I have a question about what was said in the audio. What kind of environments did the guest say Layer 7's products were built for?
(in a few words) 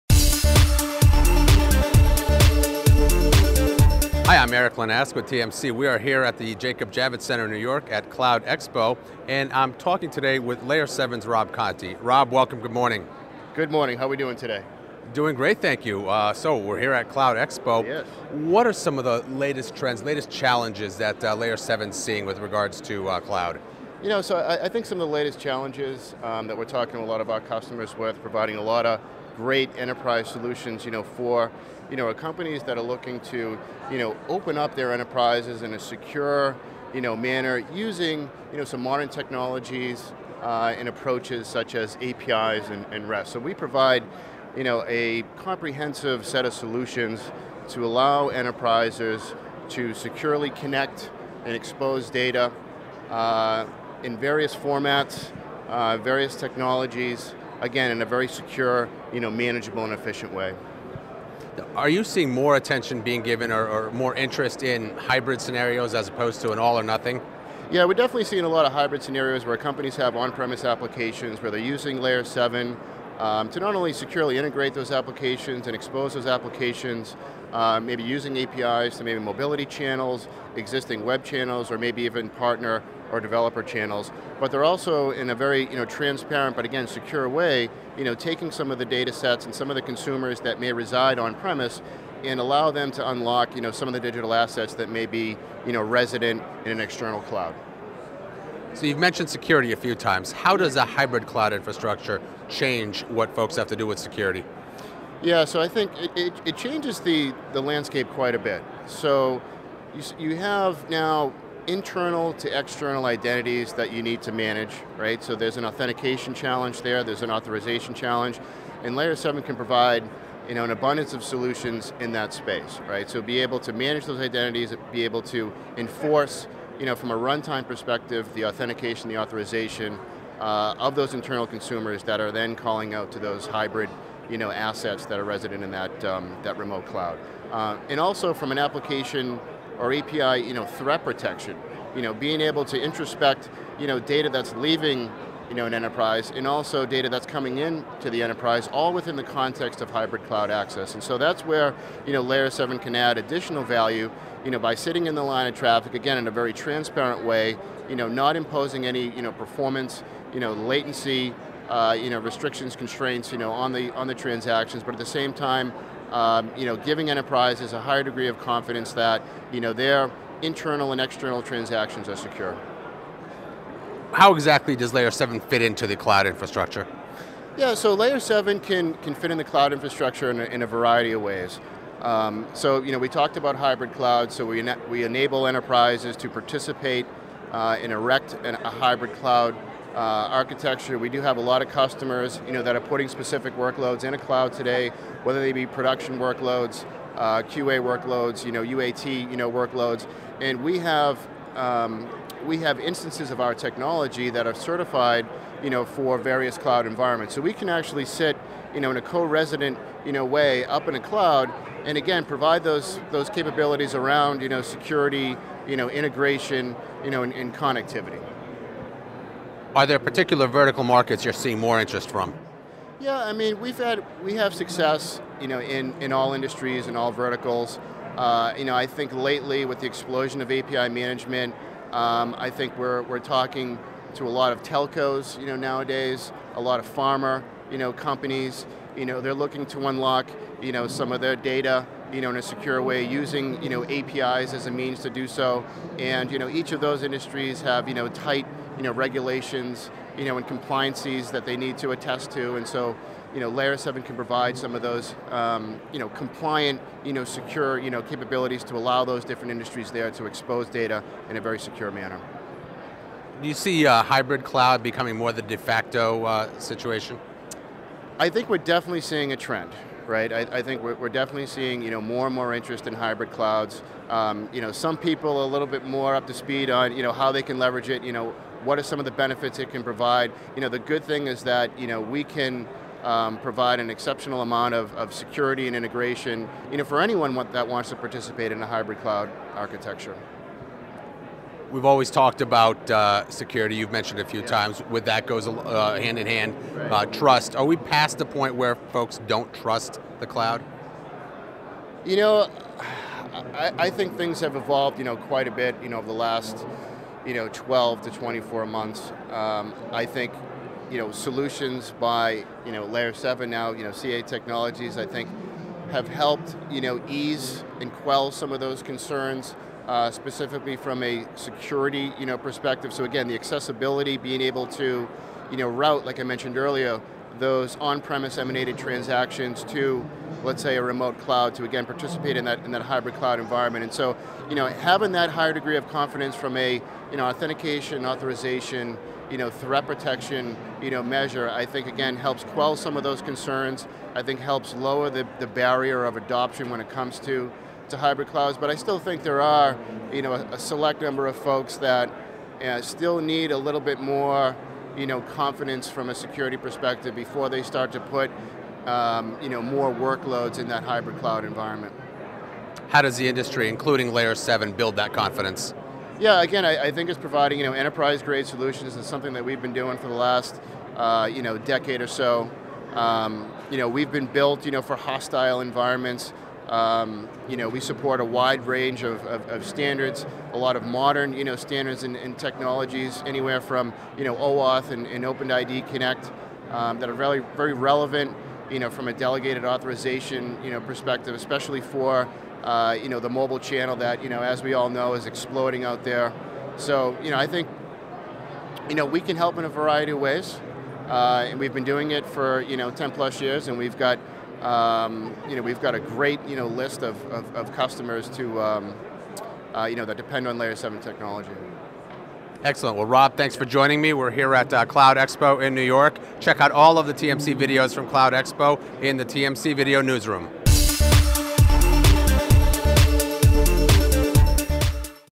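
Hostile environments.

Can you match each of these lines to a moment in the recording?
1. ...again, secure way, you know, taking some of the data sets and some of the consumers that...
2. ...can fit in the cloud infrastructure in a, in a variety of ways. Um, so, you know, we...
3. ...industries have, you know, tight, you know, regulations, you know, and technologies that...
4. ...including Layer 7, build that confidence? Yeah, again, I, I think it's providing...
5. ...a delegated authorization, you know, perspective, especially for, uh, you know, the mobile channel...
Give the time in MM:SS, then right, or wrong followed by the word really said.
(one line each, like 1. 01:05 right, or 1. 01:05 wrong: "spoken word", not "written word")
1. 01:26 right
2. 02:58 right
3. 04:07 wrong: "compliances", not "technologies"
4. 06:03 right
5. 06:29 right.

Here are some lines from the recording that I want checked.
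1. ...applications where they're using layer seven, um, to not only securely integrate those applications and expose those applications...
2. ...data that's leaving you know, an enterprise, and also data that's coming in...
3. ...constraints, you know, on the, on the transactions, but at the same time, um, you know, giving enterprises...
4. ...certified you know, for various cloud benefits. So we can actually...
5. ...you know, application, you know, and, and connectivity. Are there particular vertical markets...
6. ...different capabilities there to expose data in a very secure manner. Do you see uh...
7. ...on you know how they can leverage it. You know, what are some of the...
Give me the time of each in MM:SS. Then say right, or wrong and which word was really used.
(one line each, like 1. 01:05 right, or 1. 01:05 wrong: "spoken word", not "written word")
1. 01:10 right
2. 02:23 right
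3. 02:42 right
4. 03:24 wrong: "environments", not "benefits"
5. 03:35 wrong: "integration", not "application"
6. 04:19 wrong: "industries", not "capabilities"
7. 04:36 right.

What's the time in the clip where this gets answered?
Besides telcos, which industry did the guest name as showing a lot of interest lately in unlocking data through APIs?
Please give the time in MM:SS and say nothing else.
03:56.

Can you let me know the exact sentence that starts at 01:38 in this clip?
So you've mentioned security a few times.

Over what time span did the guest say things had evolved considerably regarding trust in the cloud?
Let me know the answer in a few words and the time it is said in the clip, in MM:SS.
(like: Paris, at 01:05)
12 to 24 months, at 05:07.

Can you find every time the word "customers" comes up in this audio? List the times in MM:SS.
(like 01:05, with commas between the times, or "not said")
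00:27, 03:11, 06:47.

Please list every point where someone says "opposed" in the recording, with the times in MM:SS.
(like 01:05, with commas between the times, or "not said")
01:06.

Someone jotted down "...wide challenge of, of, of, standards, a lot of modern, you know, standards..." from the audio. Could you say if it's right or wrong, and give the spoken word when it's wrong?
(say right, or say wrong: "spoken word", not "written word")
wrong: "range", not "challenge".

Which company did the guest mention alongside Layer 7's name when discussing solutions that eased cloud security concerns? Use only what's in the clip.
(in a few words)
CA Technologies.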